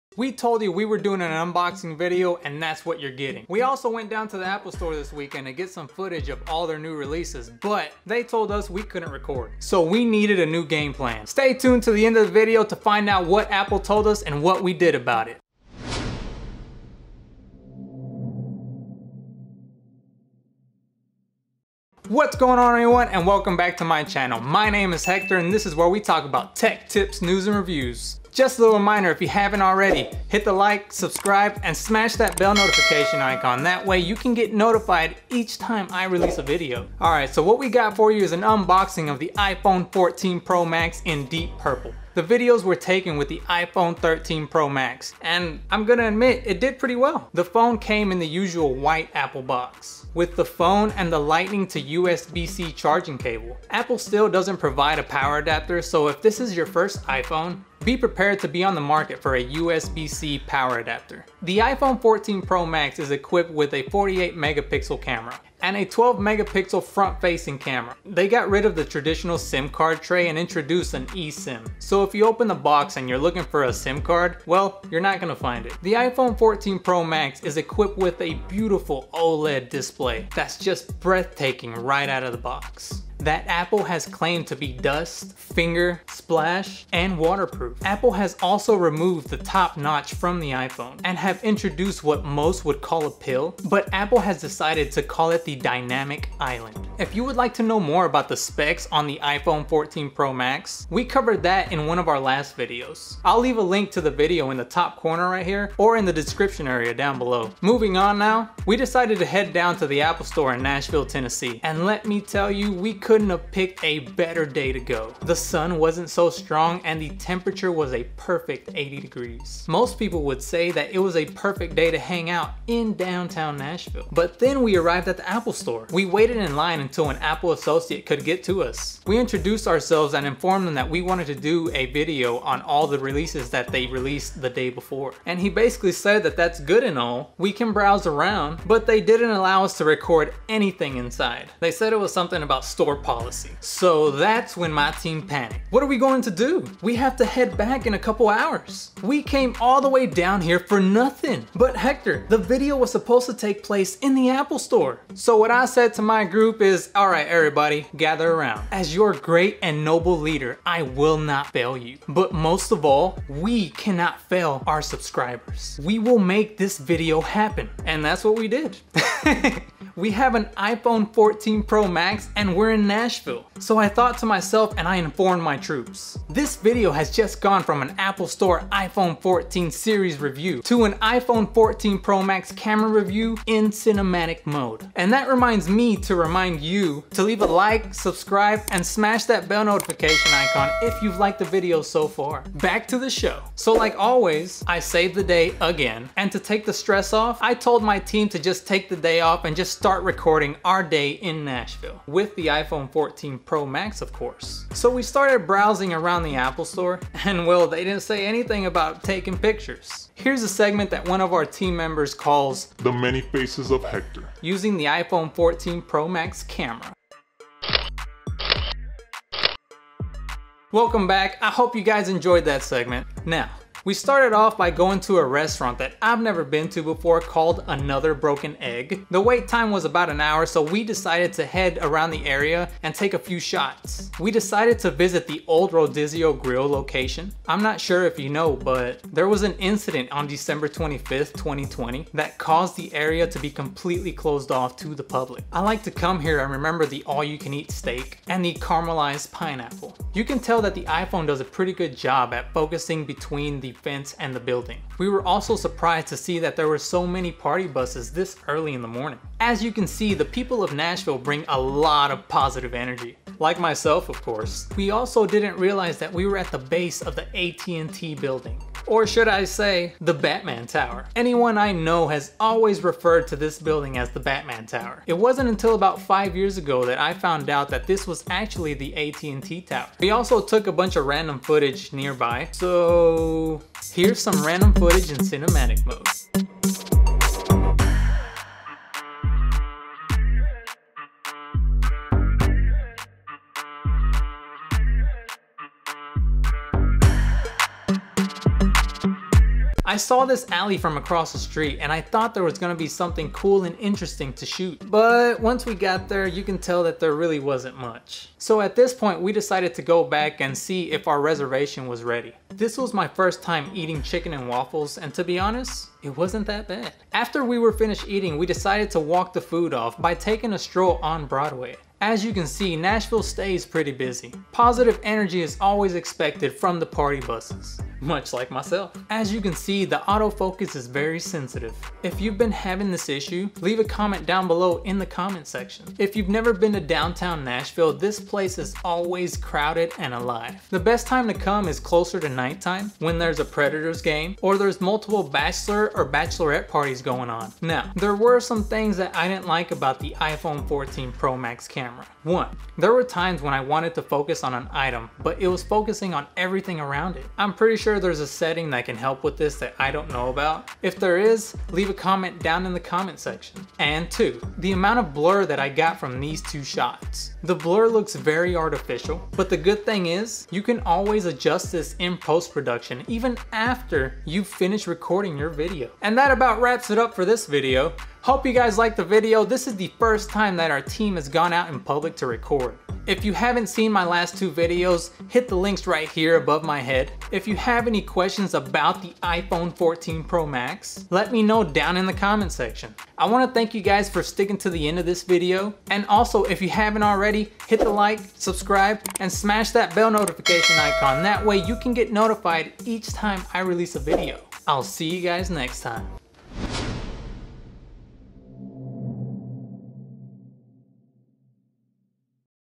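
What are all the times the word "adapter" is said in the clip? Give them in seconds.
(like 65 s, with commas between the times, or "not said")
55 s, 60 s.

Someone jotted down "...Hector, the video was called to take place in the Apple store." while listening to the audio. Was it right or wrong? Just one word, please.
wrong.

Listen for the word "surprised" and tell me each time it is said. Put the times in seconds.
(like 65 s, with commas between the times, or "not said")
255 s.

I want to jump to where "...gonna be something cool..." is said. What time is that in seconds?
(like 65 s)
302 s.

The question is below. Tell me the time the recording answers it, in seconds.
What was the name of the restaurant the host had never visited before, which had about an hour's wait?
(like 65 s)
227 s.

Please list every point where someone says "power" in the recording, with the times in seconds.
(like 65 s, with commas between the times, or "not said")
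55 s, 60 s.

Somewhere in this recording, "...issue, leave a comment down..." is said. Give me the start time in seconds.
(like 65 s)
333 s.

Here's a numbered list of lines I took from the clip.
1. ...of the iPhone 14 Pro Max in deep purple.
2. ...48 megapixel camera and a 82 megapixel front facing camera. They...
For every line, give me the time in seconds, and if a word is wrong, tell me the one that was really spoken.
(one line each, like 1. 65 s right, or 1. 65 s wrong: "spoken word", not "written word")
1. 39 s right
2. 63 s wrong: "12", not "82".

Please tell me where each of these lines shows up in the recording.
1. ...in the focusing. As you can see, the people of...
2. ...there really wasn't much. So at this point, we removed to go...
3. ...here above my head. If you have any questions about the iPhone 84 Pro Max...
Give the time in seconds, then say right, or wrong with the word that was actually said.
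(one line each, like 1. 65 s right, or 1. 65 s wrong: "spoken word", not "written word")
1. 258 s wrong: "morning", not "focusing"
2. 307 s wrong: "decided", not "removed"
3. 386 s wrong: "14", not "84".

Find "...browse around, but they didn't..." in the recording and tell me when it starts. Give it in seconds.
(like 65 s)
137 s.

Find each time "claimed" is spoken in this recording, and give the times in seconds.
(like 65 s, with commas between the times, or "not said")
84 s.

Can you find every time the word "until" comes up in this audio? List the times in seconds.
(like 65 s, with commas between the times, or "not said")
126 s, 275 s.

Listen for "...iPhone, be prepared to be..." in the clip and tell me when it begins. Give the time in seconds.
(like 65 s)
57 s.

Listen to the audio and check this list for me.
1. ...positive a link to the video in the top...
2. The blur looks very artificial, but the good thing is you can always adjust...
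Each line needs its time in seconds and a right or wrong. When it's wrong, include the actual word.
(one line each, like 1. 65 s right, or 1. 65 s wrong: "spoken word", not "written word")
1. 103 s wrong: "leave", not "positive"
2. 367 s right.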